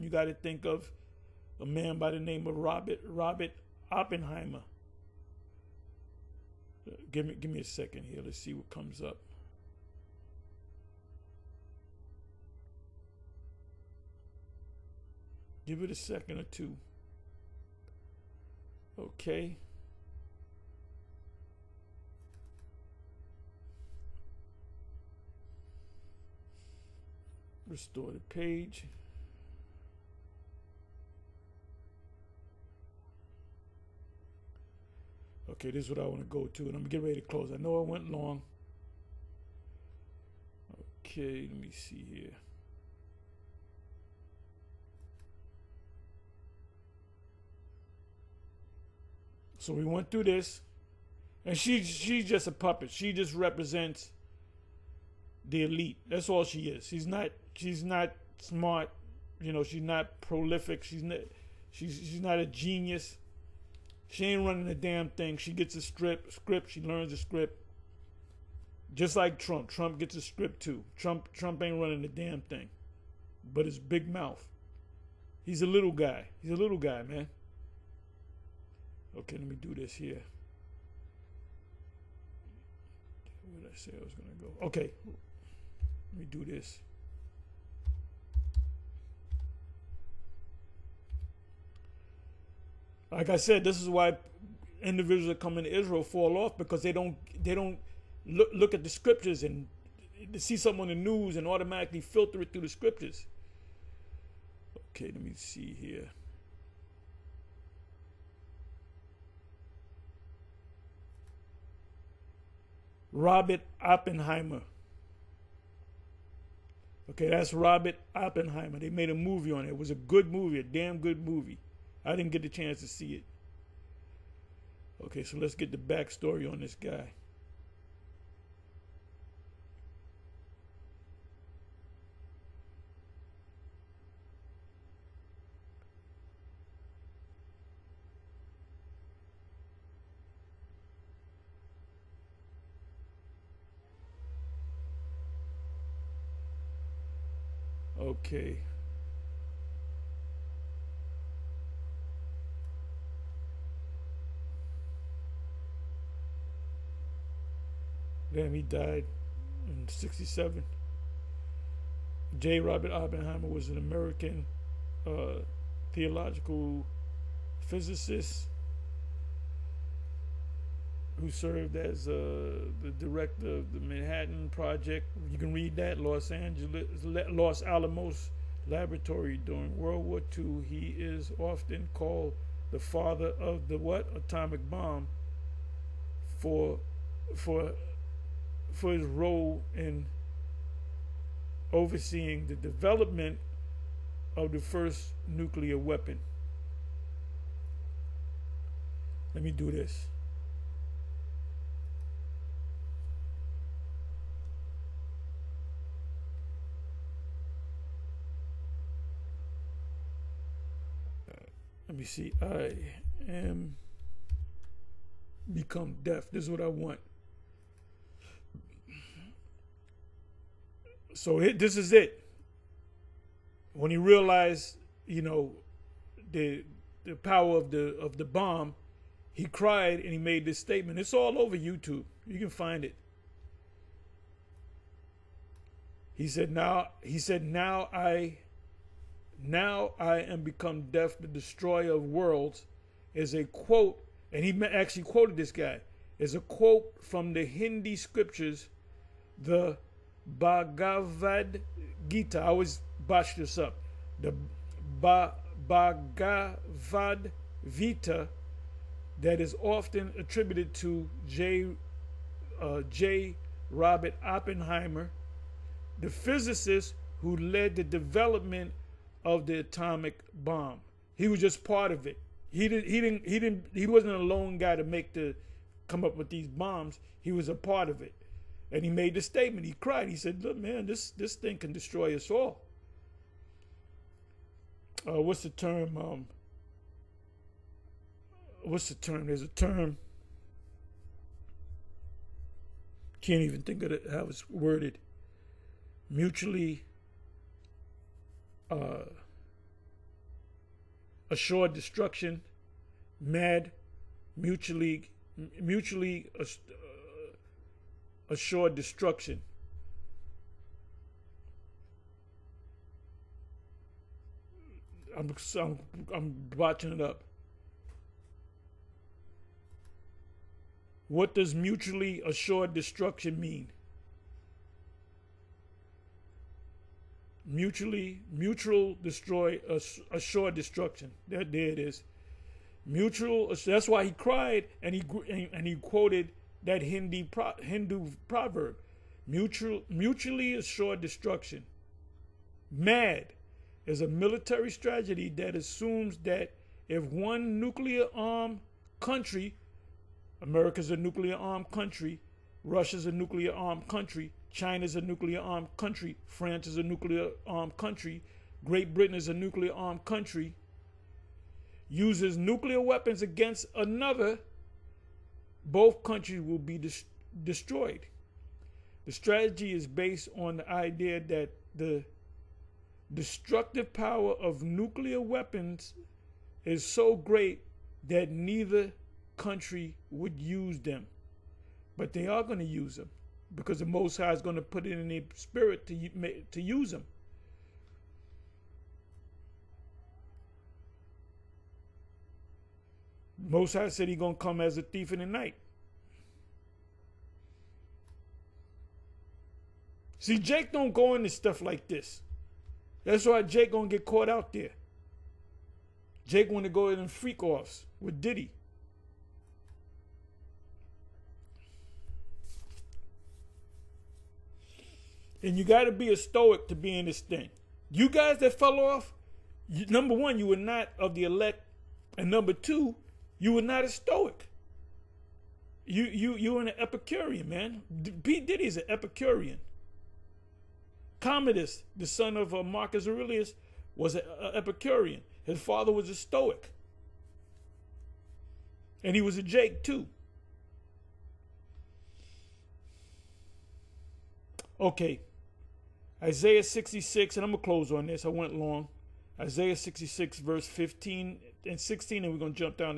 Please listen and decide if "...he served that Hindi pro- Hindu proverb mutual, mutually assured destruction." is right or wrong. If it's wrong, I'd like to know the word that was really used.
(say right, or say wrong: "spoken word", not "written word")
wrong: "quoted", not "served".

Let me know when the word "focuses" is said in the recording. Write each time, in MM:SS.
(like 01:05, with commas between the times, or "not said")
not said.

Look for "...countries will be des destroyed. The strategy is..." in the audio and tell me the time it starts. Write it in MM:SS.
06:06.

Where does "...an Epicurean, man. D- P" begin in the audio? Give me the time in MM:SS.
07:06.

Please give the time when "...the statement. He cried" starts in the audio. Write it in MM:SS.
04:39.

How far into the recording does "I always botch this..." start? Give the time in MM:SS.
04:12.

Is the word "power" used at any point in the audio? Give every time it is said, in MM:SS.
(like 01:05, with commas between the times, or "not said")
03:47, 06:13.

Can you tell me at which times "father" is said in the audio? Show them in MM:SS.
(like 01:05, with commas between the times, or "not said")
03:02, 07:15.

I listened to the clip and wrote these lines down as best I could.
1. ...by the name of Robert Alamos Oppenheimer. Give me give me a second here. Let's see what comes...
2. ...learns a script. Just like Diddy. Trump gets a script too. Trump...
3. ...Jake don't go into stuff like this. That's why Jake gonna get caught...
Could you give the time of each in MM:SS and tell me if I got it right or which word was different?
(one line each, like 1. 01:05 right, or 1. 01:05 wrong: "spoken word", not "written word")
1. 00:01 wrong: "Robert", not "Alamos"
2. 01:06 wrong: "Trump", not "Diddy"
3. 06:40 right.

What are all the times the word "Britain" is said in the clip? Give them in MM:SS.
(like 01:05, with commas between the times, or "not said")
05:58.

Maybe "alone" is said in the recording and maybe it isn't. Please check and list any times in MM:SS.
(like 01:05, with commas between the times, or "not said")
not said.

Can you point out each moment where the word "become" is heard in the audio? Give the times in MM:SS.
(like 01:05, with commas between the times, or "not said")
03:35, 04:00.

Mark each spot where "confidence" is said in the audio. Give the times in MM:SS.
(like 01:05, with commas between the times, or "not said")
not said.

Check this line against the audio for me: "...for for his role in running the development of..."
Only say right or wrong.
wrong.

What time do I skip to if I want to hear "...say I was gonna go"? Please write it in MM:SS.
01:23.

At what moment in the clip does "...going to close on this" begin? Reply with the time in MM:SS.
07:27.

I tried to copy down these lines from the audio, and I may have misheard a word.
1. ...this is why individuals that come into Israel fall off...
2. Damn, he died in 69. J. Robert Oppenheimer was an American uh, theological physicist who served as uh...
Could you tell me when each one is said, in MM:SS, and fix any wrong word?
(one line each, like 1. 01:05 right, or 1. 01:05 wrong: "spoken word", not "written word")
1. 01:33 right
2. 02:38 wrong: "67", not "69".